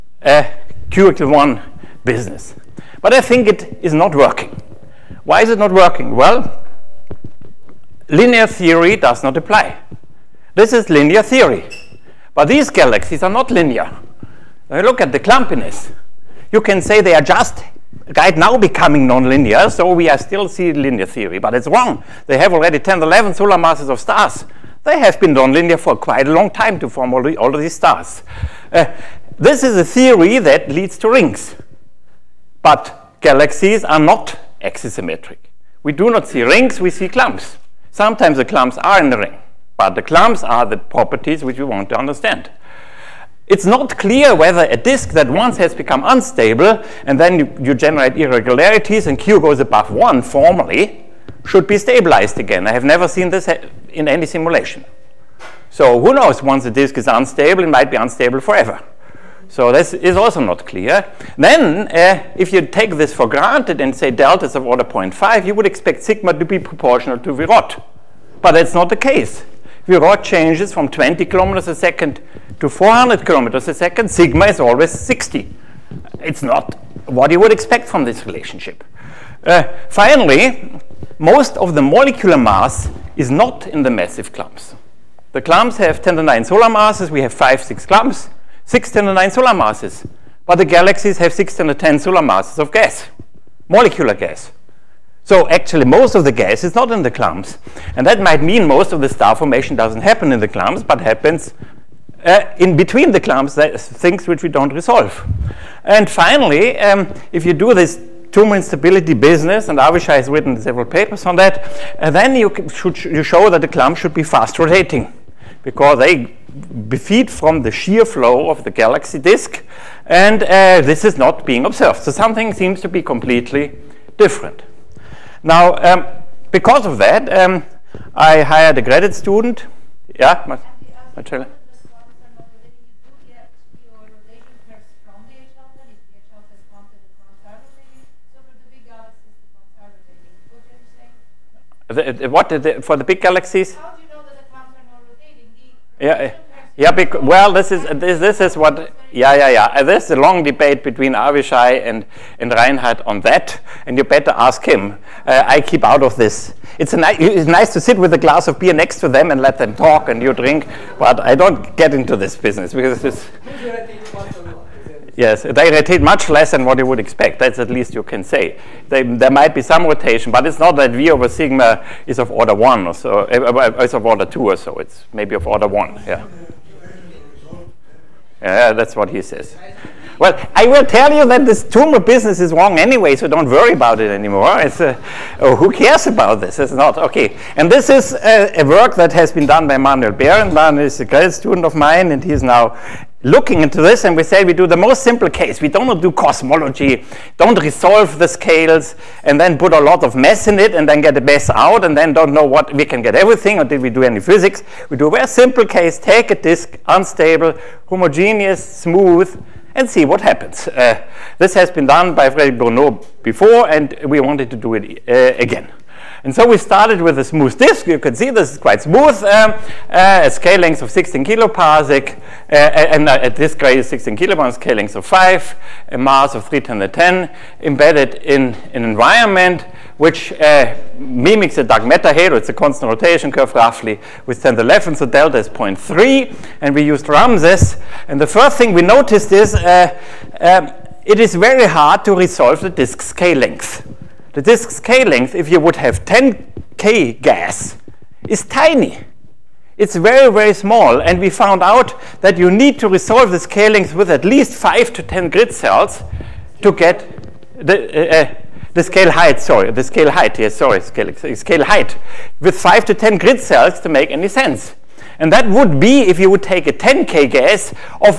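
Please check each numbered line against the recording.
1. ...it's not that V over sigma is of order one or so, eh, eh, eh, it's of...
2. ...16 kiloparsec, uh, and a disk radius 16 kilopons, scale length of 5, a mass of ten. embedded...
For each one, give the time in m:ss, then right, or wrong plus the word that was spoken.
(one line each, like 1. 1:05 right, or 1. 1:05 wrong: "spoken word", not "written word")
1. 2:50 right
2. 3:40 right.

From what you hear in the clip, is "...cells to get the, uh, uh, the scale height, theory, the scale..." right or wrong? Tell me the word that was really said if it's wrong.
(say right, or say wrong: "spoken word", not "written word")
wrong: "sorry", not "theory".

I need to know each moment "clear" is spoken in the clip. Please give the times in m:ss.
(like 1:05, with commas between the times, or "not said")
0:43, 1:00.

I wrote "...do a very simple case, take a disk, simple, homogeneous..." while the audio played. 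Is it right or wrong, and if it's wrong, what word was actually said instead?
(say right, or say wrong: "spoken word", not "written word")
wrong: "unstable", not "simple".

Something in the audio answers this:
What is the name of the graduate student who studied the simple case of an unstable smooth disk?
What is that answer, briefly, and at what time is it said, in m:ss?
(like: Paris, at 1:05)
Manuel Behrendt, at 3:09.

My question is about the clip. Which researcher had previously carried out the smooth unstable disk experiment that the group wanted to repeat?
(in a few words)
Frederic Bournaud.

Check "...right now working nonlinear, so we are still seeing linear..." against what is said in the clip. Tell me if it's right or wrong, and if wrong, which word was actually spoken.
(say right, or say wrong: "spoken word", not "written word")
wrong: "becoming", not "working".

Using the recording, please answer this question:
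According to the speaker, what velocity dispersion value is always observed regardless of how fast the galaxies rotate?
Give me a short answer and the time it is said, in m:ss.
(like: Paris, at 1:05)
60, at 1:14.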